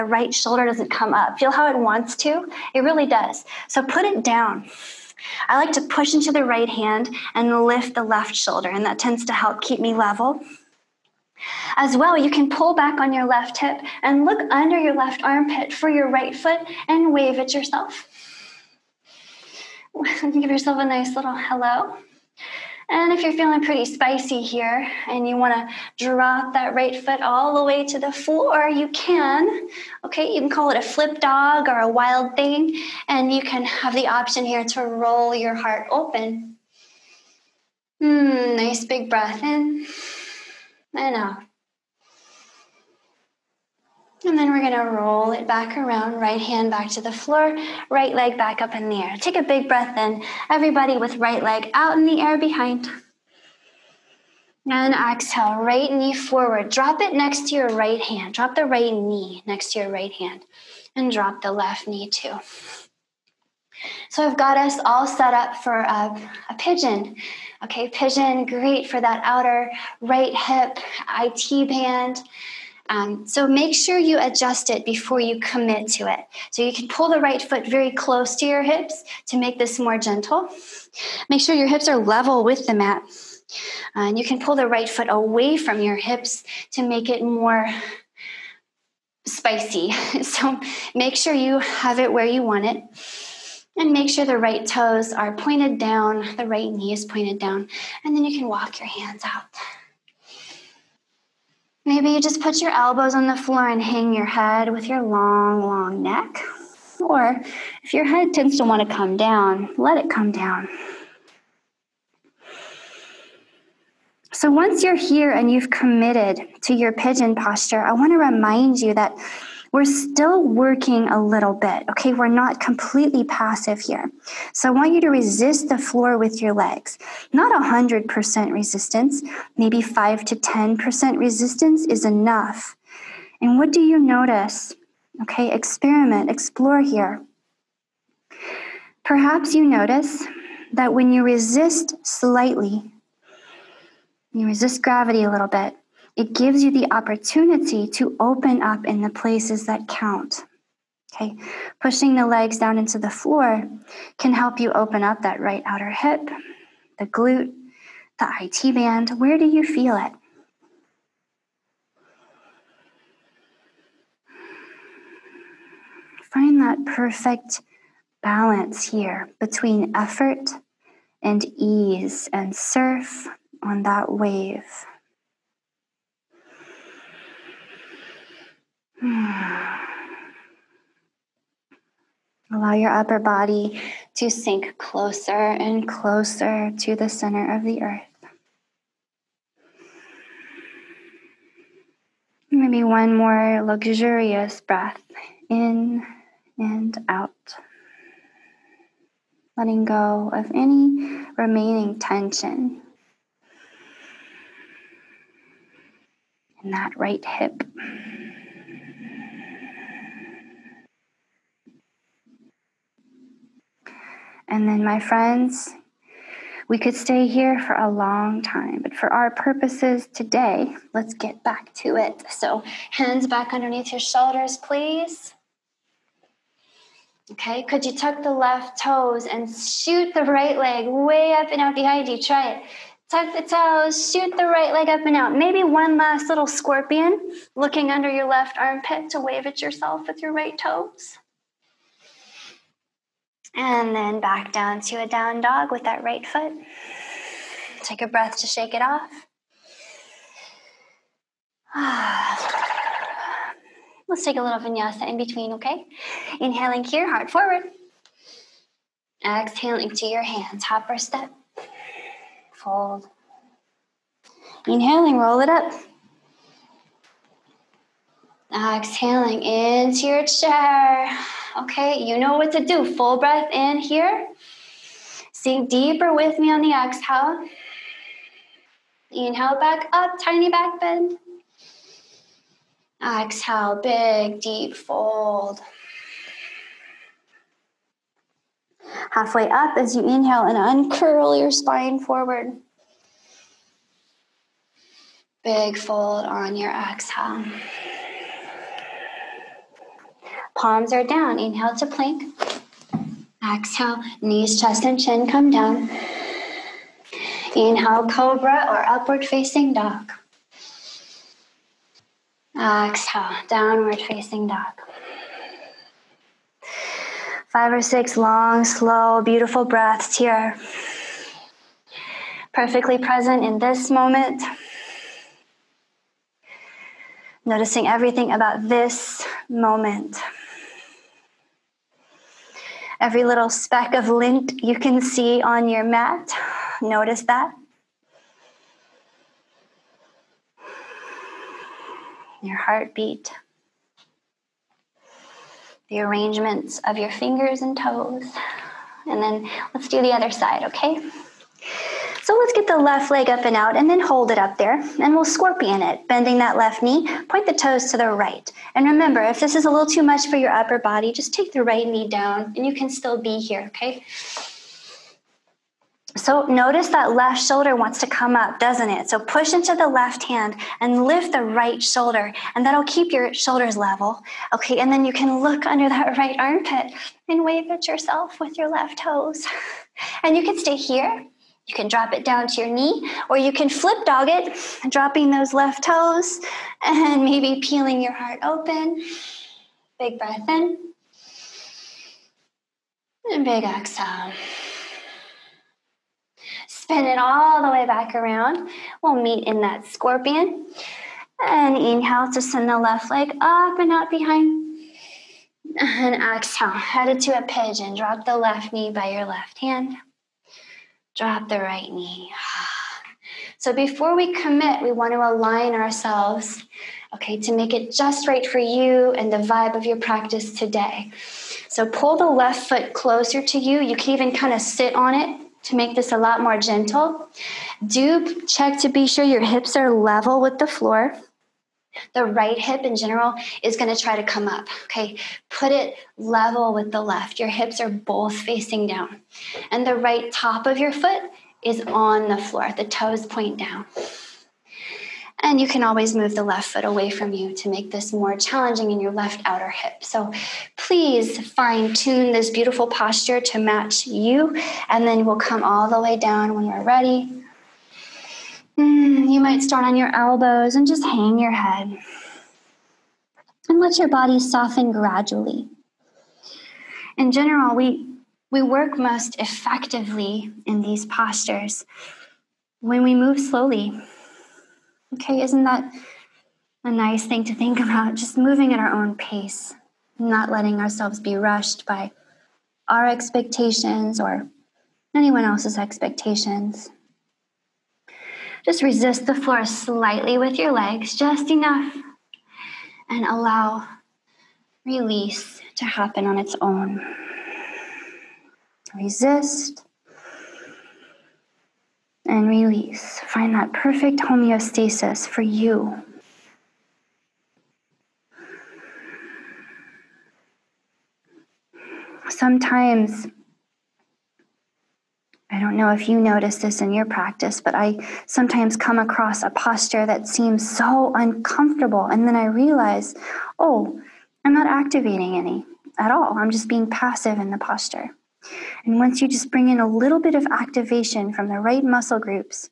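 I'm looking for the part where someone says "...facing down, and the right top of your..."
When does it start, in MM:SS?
07:18.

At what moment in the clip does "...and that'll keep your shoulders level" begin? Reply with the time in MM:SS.
06:12.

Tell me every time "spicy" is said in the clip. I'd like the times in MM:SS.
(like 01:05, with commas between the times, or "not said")
00:23, 01:29.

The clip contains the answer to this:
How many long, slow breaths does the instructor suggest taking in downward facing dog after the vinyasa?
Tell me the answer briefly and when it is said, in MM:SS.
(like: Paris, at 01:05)
5 or 6, at 05:17.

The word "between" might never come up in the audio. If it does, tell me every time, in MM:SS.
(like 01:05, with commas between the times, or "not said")
02:49, 04:15.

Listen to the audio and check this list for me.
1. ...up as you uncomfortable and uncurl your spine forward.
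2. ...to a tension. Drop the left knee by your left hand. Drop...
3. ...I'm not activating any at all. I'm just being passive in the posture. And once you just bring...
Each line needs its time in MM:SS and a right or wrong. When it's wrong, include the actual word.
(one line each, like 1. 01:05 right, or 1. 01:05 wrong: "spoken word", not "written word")
1. 04:49 wrong: "inhale", not "uncomfortable"
2. 06:47 wrong: "pigeon", not "tension"
3. 08:44 right.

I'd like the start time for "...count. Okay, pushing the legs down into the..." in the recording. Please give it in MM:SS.
02:29.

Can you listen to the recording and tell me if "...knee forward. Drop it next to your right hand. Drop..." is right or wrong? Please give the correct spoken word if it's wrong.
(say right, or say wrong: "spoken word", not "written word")
right.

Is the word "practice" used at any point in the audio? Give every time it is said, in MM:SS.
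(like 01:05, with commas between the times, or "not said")
06:59, 08:37.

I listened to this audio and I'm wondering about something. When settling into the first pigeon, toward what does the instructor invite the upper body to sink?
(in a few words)
center of the earth.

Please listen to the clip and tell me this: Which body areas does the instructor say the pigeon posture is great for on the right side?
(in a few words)
outer right hip IT band.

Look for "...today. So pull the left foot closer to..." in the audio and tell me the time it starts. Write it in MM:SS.
07:00.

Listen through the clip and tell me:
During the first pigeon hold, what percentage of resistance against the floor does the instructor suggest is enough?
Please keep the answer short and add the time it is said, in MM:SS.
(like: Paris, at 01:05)
5 to 10%, at 02:09.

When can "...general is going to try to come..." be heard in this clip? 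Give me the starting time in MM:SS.
07:12.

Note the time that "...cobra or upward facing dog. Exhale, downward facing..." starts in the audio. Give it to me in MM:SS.
05:08.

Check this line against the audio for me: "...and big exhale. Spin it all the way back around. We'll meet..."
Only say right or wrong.
right.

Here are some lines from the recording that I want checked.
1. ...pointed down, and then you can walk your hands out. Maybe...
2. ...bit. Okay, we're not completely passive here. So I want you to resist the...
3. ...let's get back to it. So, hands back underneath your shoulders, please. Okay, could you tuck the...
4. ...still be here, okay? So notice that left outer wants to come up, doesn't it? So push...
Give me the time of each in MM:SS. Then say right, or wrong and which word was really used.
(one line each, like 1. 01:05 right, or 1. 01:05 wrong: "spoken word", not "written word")
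1. 01:37 right
2. 02:01 right
3. 03:40 right
4. 06:02 wrong: "shoulder", not "outer".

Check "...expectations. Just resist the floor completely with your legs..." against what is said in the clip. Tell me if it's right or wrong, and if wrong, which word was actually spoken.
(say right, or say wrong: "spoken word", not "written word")
wrong: "slightly", not "completely".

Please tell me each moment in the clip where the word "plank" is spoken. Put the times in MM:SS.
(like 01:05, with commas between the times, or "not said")
05:01.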